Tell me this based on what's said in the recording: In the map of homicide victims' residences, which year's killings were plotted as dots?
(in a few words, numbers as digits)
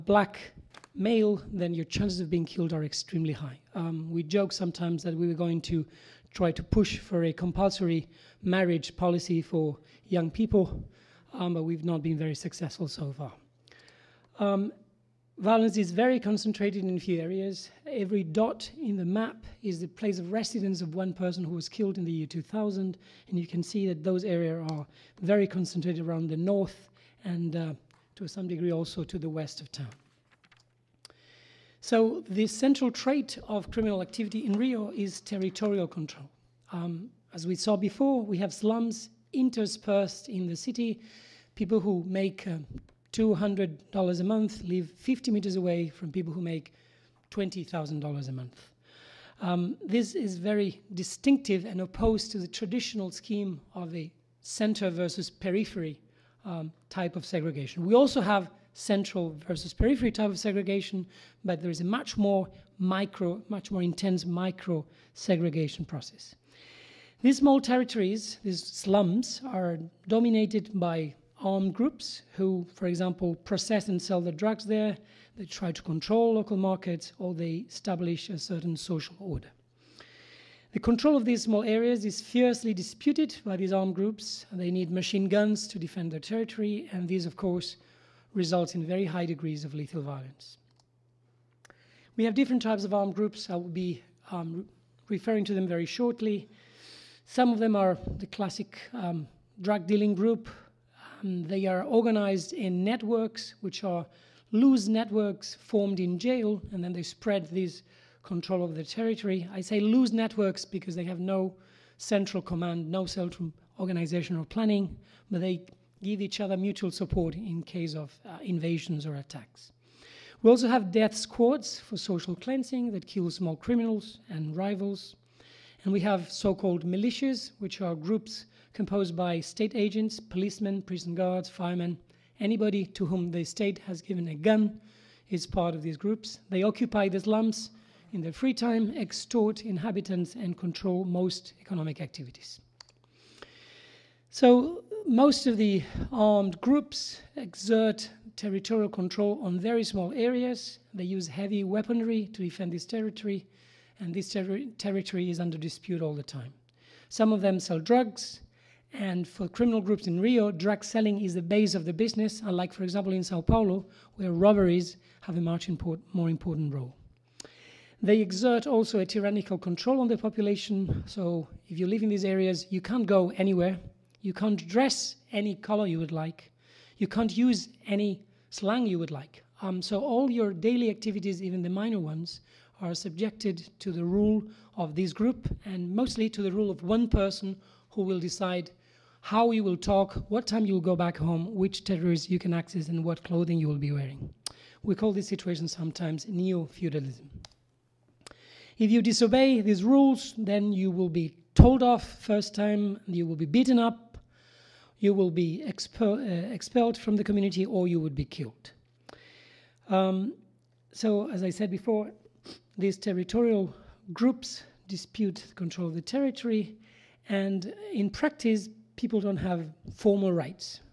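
2000.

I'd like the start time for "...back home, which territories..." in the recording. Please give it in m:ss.
3:10.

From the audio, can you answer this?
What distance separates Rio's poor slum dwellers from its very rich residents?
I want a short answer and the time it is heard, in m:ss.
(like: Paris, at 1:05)
50 meters, at 0:44.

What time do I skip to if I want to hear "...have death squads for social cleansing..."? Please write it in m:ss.
2:00.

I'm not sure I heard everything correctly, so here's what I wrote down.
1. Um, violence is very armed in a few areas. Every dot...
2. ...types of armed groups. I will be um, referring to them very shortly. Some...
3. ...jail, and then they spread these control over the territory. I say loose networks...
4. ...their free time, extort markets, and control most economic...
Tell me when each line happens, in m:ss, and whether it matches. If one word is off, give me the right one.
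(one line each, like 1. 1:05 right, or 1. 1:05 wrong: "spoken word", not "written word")
1. 0:14 wrong: "concentrated", not "armed"
2. 1:32 right
3. 1:46 right
4. 2:18 wrong: "inhabitants", not "markets".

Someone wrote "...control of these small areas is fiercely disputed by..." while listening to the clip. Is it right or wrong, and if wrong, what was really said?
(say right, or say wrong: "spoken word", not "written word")
right.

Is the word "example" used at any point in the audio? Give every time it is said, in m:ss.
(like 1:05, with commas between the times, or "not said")
1:12, 2:42.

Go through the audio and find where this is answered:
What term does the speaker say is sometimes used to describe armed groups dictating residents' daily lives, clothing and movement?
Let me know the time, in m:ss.
3:16.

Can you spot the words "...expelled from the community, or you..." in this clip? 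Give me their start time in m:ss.
3:26.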